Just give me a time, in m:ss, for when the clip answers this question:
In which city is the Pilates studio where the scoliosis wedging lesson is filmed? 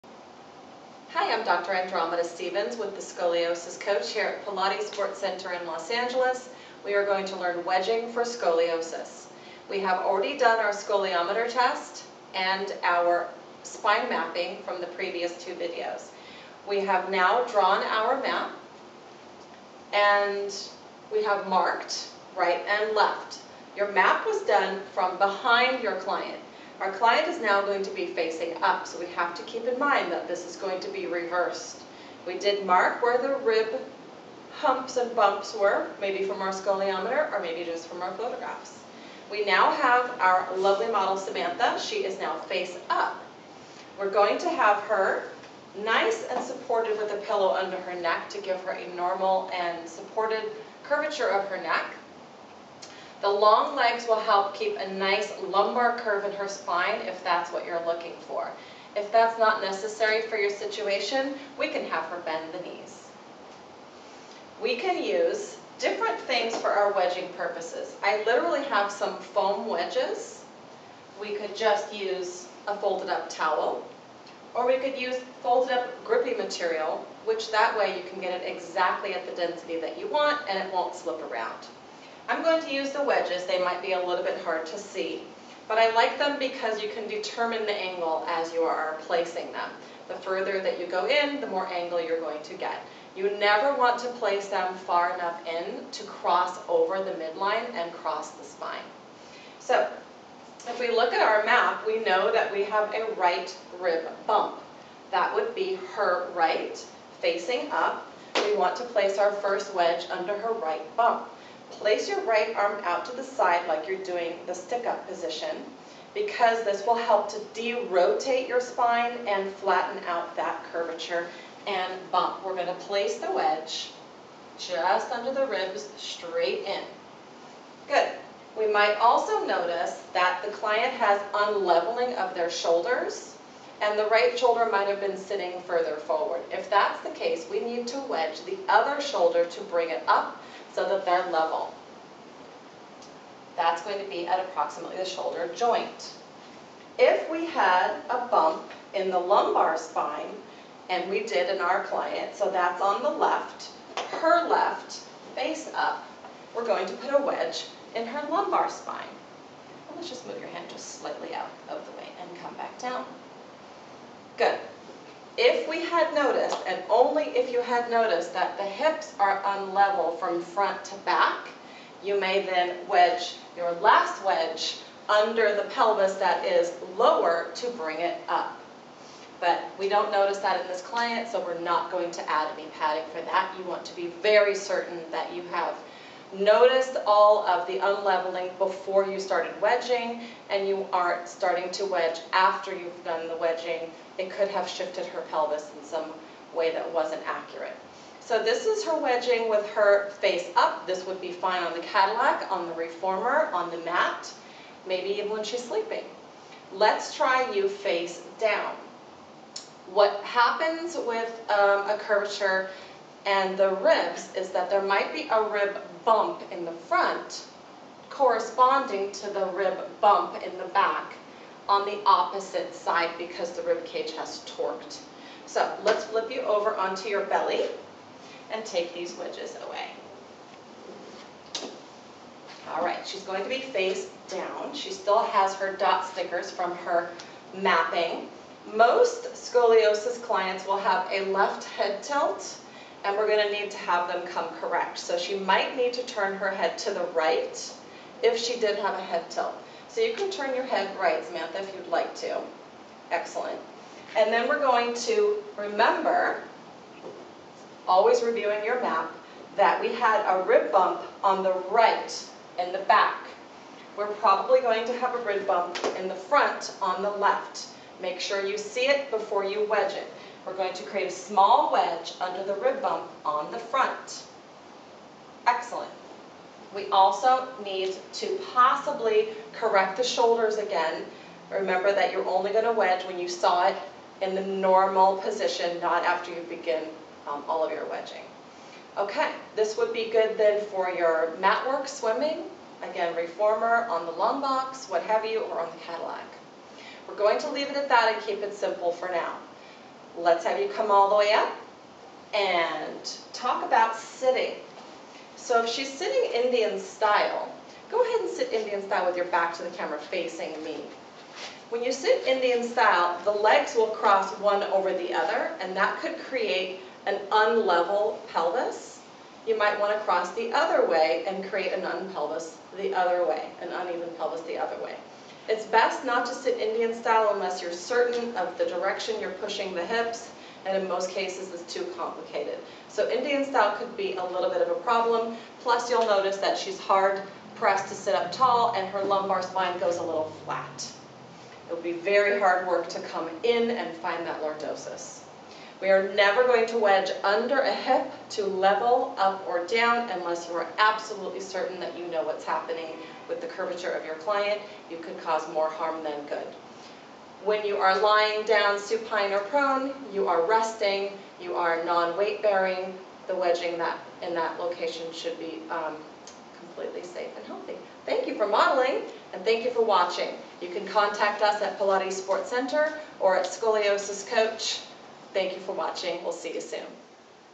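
0:05.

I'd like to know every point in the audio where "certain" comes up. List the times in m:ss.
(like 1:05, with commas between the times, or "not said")
3:04, 5:27, 5:51.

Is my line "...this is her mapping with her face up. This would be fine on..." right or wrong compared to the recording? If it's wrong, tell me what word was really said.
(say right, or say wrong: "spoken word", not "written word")
wrong: "wedging", not "mapping".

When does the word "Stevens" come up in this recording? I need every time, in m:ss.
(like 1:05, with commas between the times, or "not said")
0:02.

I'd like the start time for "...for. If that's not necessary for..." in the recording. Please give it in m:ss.
0:58.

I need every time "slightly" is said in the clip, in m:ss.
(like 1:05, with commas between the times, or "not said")
2:40.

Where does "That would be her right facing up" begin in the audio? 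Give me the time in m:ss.
1:45.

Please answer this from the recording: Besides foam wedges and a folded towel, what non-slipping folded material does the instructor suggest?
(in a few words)
grippy material.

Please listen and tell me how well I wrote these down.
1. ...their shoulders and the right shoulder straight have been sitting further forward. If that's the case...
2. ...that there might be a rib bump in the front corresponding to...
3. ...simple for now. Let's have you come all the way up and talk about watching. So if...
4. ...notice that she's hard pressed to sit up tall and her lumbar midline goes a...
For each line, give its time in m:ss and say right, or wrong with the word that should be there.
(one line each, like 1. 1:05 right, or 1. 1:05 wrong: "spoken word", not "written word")
1. 2:12 wrong: "might", not "straight"
2. 3:34 right
3. 4:58 wrong: "sitting", not "watching"
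4. 5:36 wrong: "spine", not "midline".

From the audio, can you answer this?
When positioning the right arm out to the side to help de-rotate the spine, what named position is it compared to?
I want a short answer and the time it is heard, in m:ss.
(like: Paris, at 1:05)
stick-up position, at 1:54.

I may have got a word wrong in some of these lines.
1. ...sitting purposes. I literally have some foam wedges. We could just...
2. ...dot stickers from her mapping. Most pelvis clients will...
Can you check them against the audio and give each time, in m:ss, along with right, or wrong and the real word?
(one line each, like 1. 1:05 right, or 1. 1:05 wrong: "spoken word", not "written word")
1. 1:06 wrong: "wedging", not "sitting"
2. 3:55 wrong: "scoliosis", not "pelvis".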